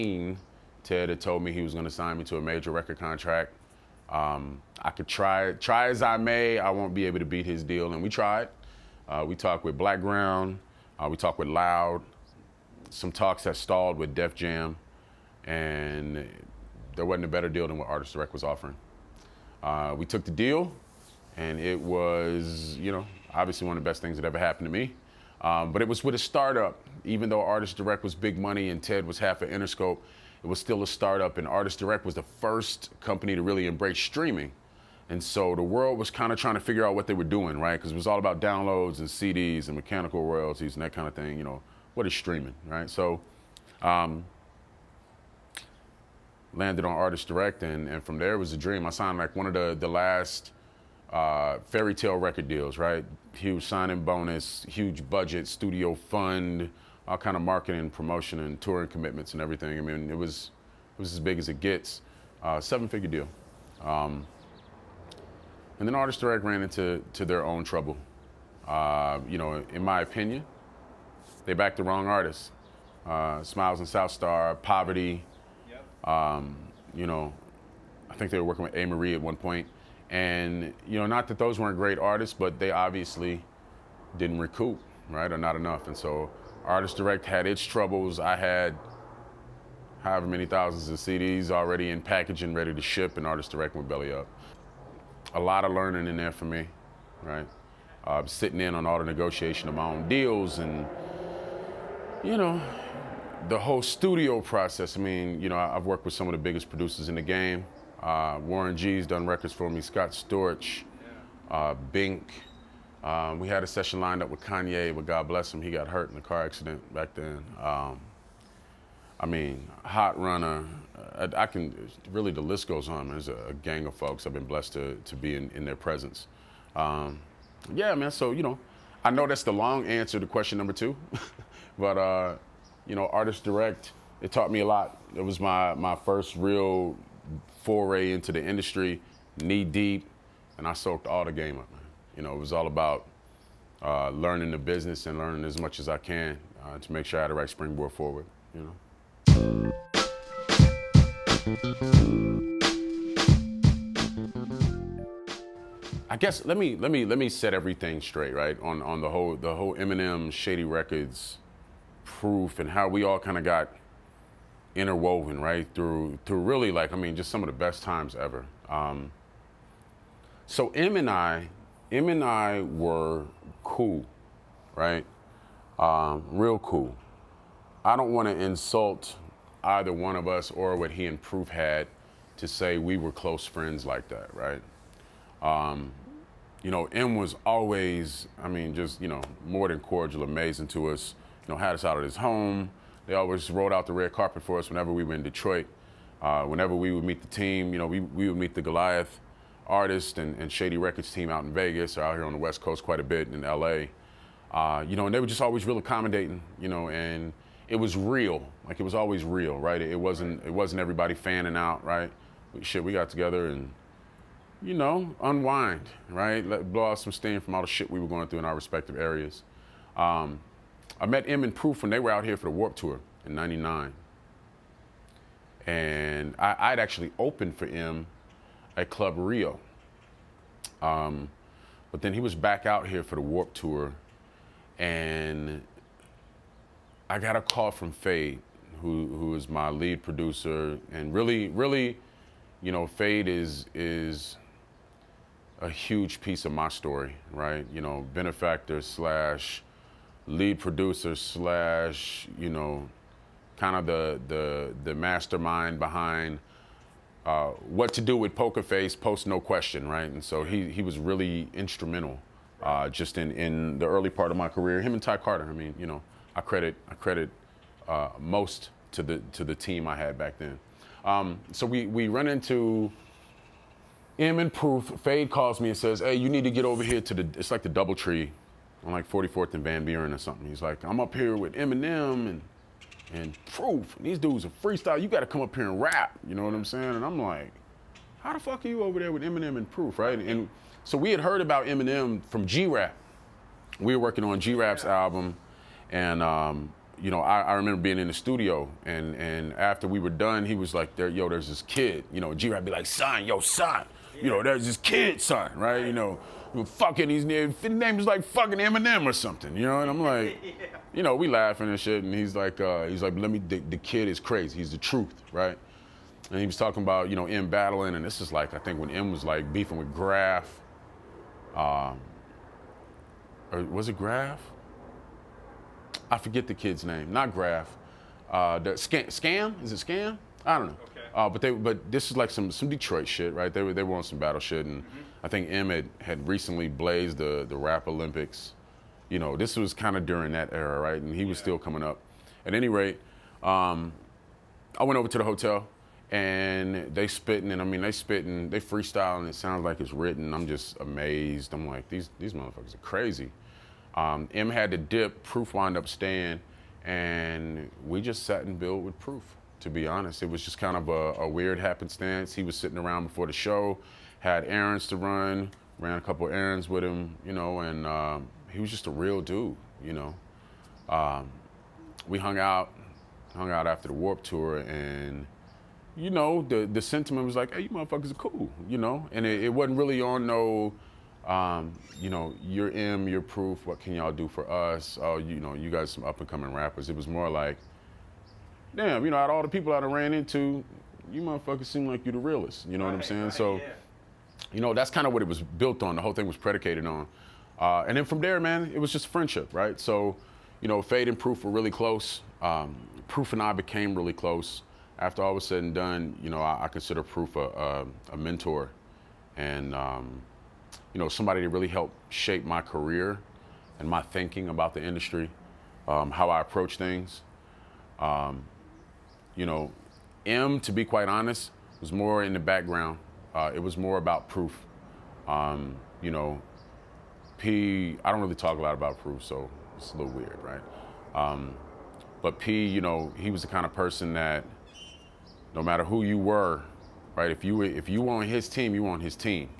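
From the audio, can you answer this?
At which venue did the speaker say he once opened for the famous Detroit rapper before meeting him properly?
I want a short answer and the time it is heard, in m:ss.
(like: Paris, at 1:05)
Club Rio, at 3:48.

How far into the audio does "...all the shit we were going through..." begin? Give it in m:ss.
3:37.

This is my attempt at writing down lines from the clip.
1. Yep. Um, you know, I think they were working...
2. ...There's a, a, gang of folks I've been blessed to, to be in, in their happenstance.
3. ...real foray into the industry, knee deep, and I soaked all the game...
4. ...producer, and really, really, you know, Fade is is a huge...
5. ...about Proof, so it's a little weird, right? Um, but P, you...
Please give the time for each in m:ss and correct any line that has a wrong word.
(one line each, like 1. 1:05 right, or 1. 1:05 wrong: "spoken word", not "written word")
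1. 1:15 right
2. 2:03 wrong: "presence", not "happenstance"
3. 2:16 right
4. 4:00 right
5. 7:08 right.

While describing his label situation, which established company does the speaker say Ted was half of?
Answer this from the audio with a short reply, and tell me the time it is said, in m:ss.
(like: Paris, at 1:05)
Interscope, at 0:29.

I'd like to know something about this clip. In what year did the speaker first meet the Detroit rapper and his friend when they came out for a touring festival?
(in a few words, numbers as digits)
1999.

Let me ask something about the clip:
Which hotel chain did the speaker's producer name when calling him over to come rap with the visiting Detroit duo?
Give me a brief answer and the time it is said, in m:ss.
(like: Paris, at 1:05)
Doubletree, at 4:37.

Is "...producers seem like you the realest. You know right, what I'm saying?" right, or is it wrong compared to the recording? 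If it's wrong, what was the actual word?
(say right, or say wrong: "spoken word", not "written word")
wrong: "motherfuckers", not "producers".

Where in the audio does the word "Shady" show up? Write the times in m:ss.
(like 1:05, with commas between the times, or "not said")
2:40, 3:20.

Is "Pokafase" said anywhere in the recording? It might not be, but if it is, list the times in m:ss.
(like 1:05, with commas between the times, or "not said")
4:18.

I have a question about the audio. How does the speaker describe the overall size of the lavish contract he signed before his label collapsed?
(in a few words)
seven figure deal.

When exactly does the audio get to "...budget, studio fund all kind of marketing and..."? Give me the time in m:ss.
0:55.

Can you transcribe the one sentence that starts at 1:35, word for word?
A lot of learning in there for me, right?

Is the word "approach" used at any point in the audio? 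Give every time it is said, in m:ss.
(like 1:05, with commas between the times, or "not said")
6:56.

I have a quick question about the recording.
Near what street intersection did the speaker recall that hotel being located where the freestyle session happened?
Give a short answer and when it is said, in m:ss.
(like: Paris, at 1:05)
44th and Van Buren, at 4:39.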